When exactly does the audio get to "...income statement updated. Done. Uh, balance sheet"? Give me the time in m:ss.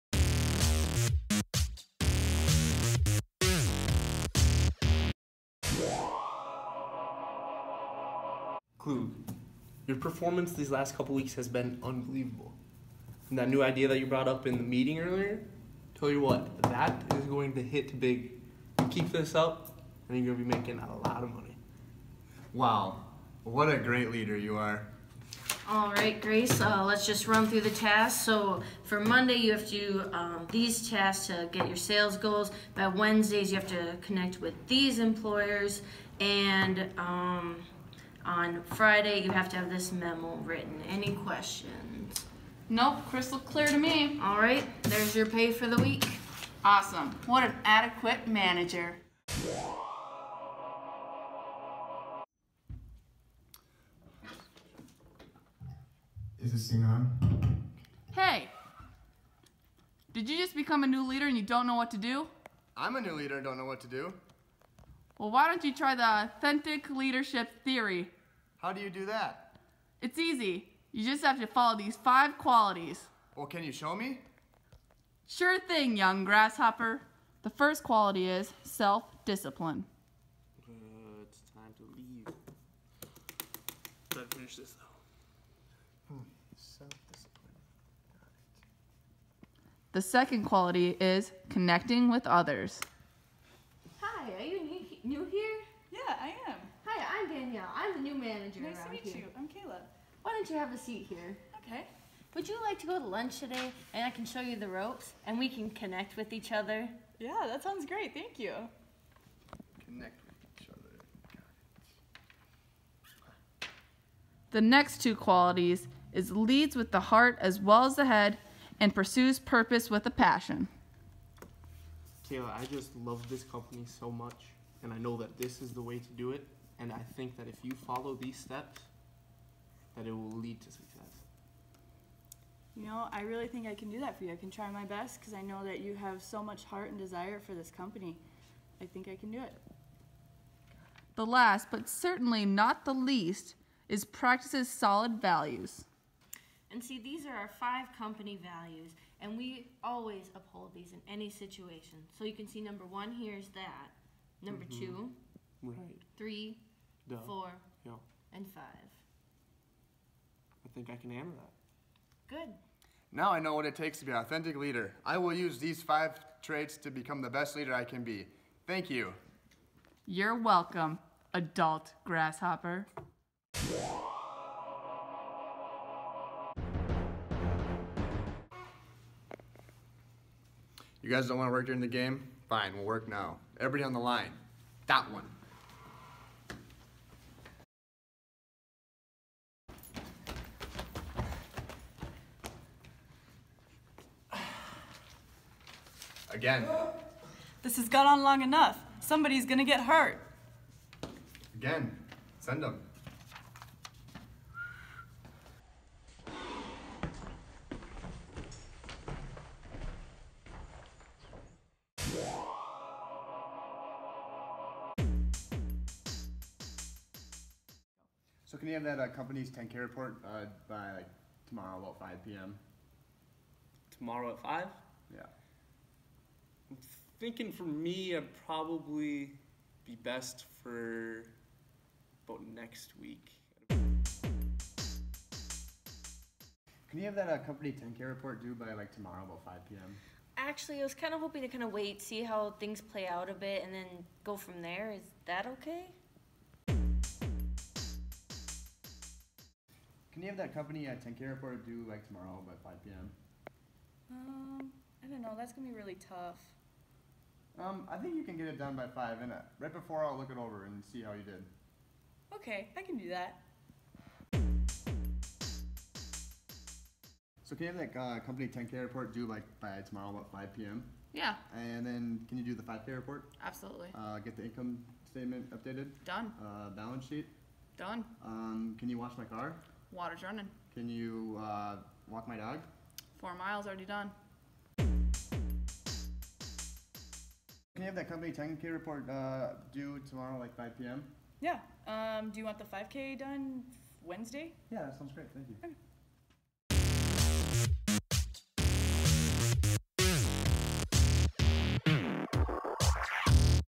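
4:34.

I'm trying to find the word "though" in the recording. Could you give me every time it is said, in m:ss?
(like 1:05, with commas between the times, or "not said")
1:24.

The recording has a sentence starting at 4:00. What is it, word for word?
Actually, I was kind of hoping to kind of wait, see how things play out a bit, and then go from there.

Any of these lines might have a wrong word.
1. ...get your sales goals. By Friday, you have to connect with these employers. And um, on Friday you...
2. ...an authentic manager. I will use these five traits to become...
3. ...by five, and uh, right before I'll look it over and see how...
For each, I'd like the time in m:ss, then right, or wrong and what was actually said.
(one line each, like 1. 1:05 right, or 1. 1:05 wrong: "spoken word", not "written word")
1. 0:31 wrong: "Wednesdays", not "Friday"
2. 2:44 wrong: "leader", not "manager"
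3. 4:18 right.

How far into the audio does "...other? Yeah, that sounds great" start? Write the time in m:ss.
1:46.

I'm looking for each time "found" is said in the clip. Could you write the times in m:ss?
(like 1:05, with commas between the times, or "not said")
not said.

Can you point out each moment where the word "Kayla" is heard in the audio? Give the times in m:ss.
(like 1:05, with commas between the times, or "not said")
1:39, 2:02.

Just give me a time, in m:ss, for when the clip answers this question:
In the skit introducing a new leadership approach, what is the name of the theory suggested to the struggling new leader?
1:06.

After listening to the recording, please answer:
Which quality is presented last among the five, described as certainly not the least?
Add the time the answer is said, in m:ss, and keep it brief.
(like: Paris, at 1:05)
Practices solid values, at 2:24.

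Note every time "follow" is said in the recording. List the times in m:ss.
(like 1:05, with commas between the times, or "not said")
1:11, 2:07.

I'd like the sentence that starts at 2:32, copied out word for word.
So you can see number one here is that, number mm -hmm.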